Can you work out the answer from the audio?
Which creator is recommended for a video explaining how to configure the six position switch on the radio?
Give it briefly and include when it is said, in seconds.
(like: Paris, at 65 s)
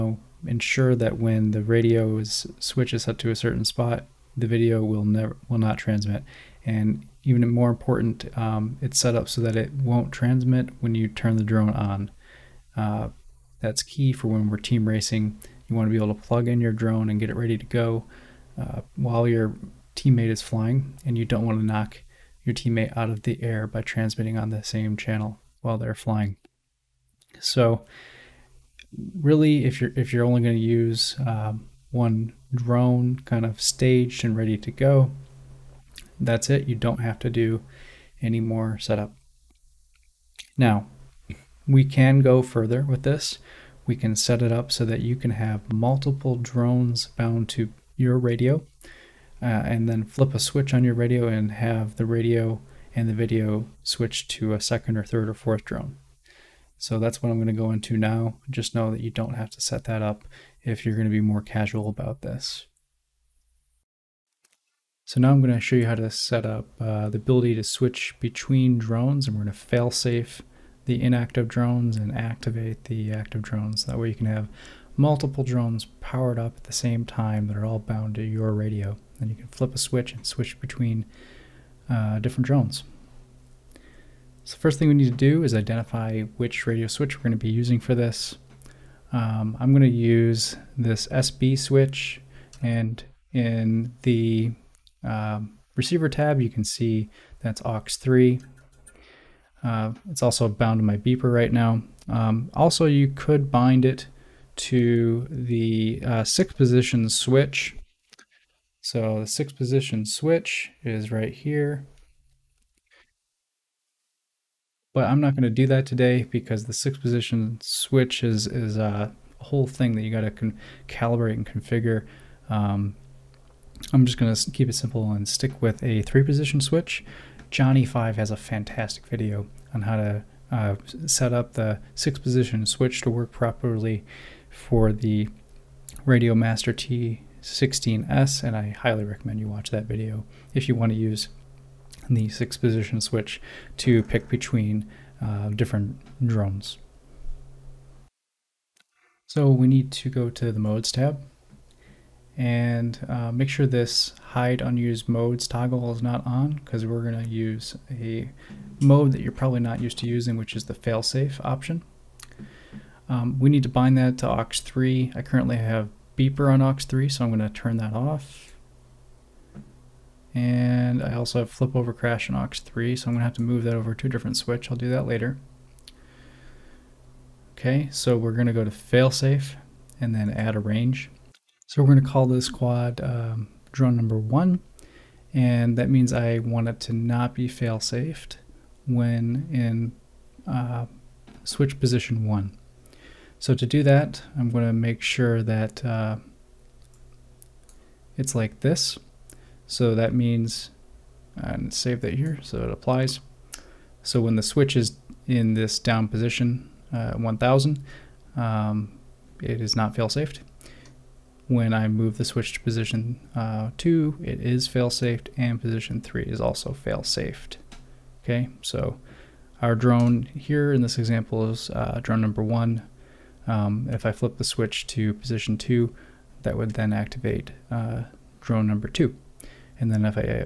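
Johnny Five, at 127 s.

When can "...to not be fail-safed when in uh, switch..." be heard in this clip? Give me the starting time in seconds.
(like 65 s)
186 s.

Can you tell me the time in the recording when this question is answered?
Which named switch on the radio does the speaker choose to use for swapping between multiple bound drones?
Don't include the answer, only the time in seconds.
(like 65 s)
91 s.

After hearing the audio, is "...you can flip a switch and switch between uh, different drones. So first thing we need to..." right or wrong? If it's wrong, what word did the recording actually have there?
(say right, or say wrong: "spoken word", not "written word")
right.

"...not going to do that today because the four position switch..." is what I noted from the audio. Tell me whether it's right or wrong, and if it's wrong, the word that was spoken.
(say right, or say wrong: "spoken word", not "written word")
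wrong: "six", not "four".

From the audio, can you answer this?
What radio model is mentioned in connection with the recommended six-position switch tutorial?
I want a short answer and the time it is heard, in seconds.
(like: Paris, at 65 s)
Radio Master T16S, at 136 s.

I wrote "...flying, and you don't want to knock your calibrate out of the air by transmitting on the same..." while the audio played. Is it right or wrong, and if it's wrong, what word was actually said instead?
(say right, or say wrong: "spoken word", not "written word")
wrong: "teammate", not "calibrate".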